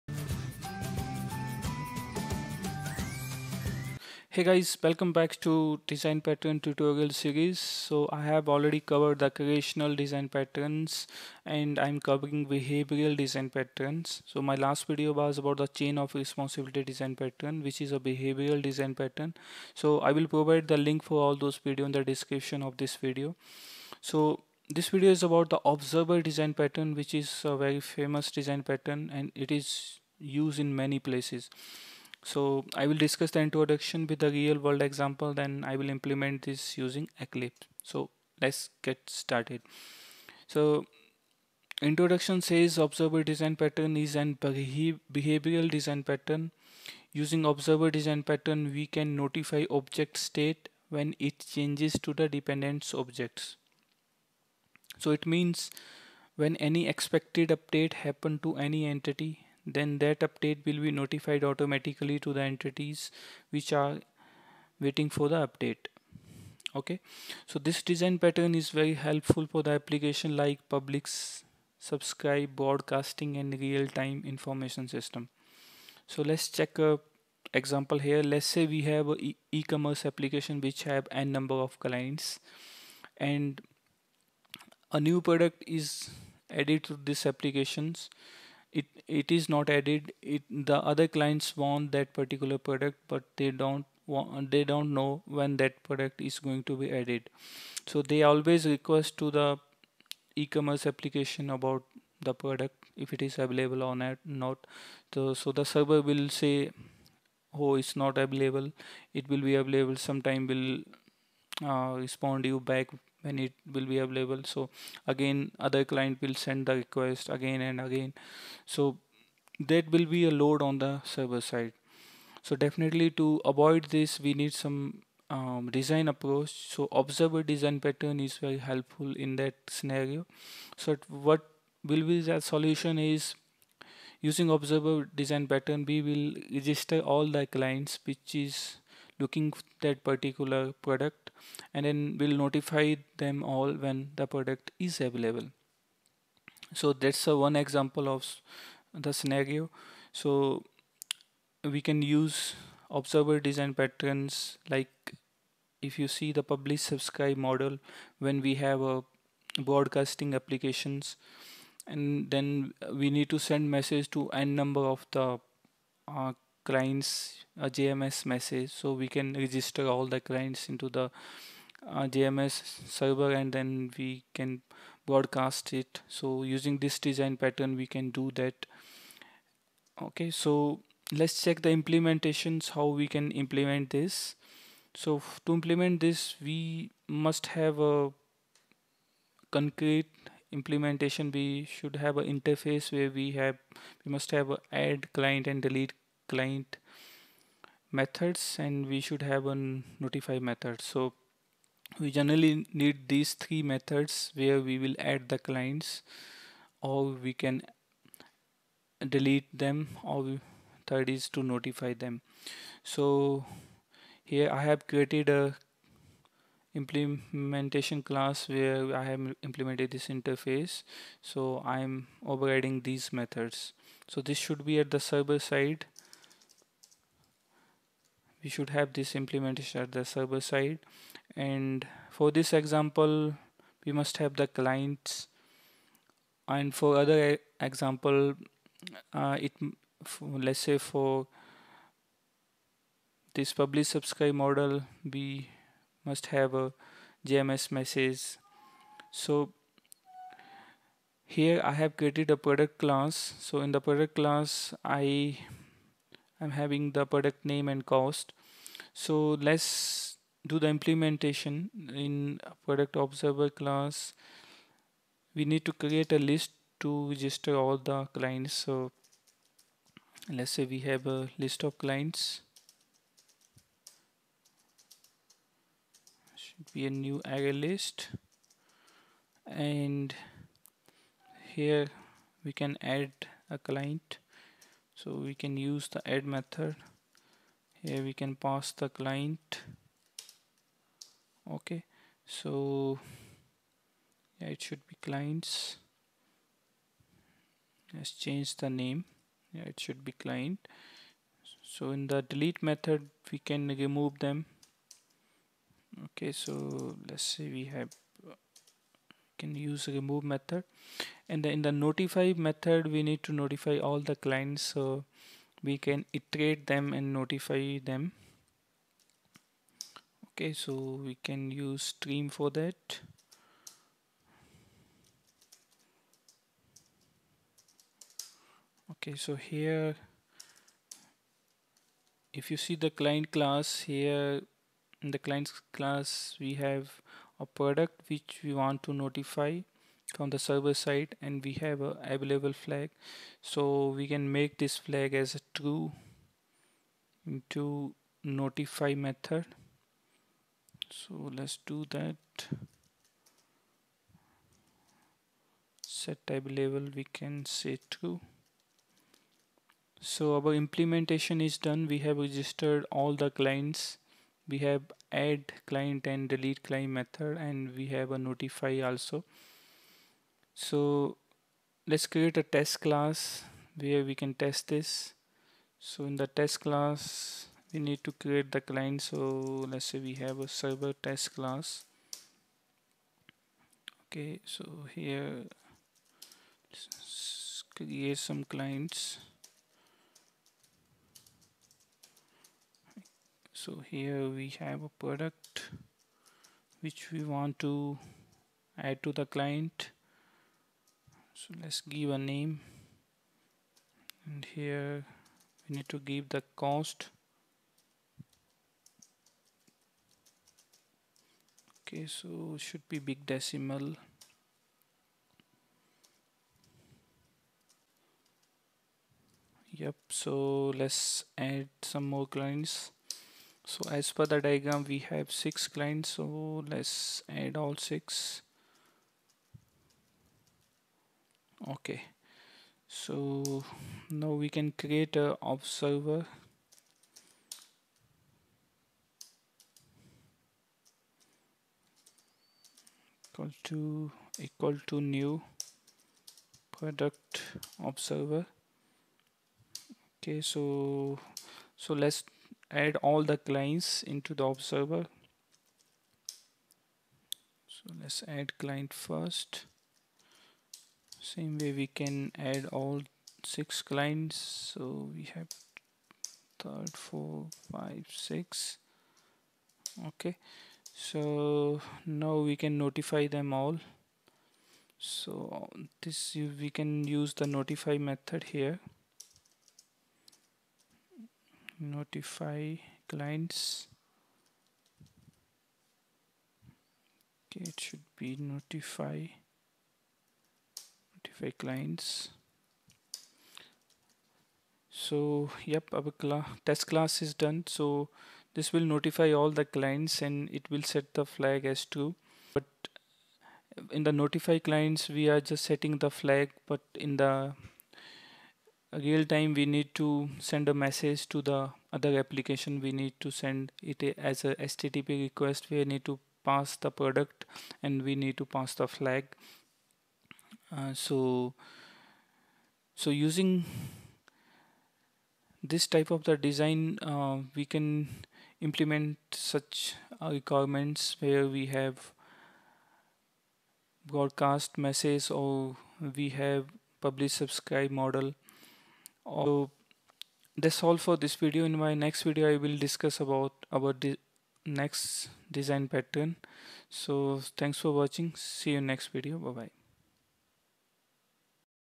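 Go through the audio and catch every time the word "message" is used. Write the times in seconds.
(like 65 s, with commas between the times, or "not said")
163 s, 168 s, 247 s, 510 s, 534 s.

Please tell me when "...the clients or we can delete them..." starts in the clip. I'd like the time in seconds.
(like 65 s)
205 s.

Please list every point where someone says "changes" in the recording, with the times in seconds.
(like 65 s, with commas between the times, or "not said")
51 s, 298 s.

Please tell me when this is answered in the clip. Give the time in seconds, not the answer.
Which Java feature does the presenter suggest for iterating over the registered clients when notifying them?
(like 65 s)
321 s.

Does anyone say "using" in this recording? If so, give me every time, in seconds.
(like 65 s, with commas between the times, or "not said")
36 s, 47 s, 134 s, 176 s, 523 s.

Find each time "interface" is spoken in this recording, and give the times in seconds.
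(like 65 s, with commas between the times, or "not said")
192 s, 220 s.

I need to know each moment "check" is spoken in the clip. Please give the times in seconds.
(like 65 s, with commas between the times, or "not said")
76 s, 181 s.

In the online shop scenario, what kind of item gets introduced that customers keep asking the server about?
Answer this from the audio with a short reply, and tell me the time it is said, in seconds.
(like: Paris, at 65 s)
a new product, at 84 s.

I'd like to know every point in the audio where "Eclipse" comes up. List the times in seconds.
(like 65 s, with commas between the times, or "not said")
37 s.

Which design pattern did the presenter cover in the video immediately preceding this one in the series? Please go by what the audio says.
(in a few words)
Chain of responsibility.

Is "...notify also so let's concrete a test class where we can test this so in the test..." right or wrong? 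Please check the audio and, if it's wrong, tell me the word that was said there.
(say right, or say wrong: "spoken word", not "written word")
wrong: "create", not "concrete".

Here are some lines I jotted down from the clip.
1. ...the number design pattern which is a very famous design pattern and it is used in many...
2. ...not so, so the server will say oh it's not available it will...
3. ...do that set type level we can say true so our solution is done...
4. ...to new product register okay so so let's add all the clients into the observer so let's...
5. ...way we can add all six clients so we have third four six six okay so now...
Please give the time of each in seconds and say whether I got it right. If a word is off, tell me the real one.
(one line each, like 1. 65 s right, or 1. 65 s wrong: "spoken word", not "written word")
1. 25 s wrong: "observer", not "number"
2. 104 s right
3. 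351 s wrong: "implementation", not "solution"
4. 444 s wrong: "observer", not "register"
5. 461 s wrong: "five", not "six".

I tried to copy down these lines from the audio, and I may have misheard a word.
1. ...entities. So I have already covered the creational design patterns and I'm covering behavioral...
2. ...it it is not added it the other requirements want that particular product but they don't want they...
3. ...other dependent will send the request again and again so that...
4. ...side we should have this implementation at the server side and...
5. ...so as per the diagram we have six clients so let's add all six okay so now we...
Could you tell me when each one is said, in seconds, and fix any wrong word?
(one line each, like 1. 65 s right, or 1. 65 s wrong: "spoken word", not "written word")
1. 7 s wrong: "series", not "entities"
2. 88 s wrong: "clients", not "requirements"
3. 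115 s wrong: "client", not "dependent"
4. 225 s right
5. 423 s right.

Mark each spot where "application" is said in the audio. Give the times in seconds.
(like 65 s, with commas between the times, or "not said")
69 s, 80 s, 87 s, 100 s, 160 s, 512 s.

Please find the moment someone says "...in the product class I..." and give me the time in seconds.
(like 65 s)
253 s.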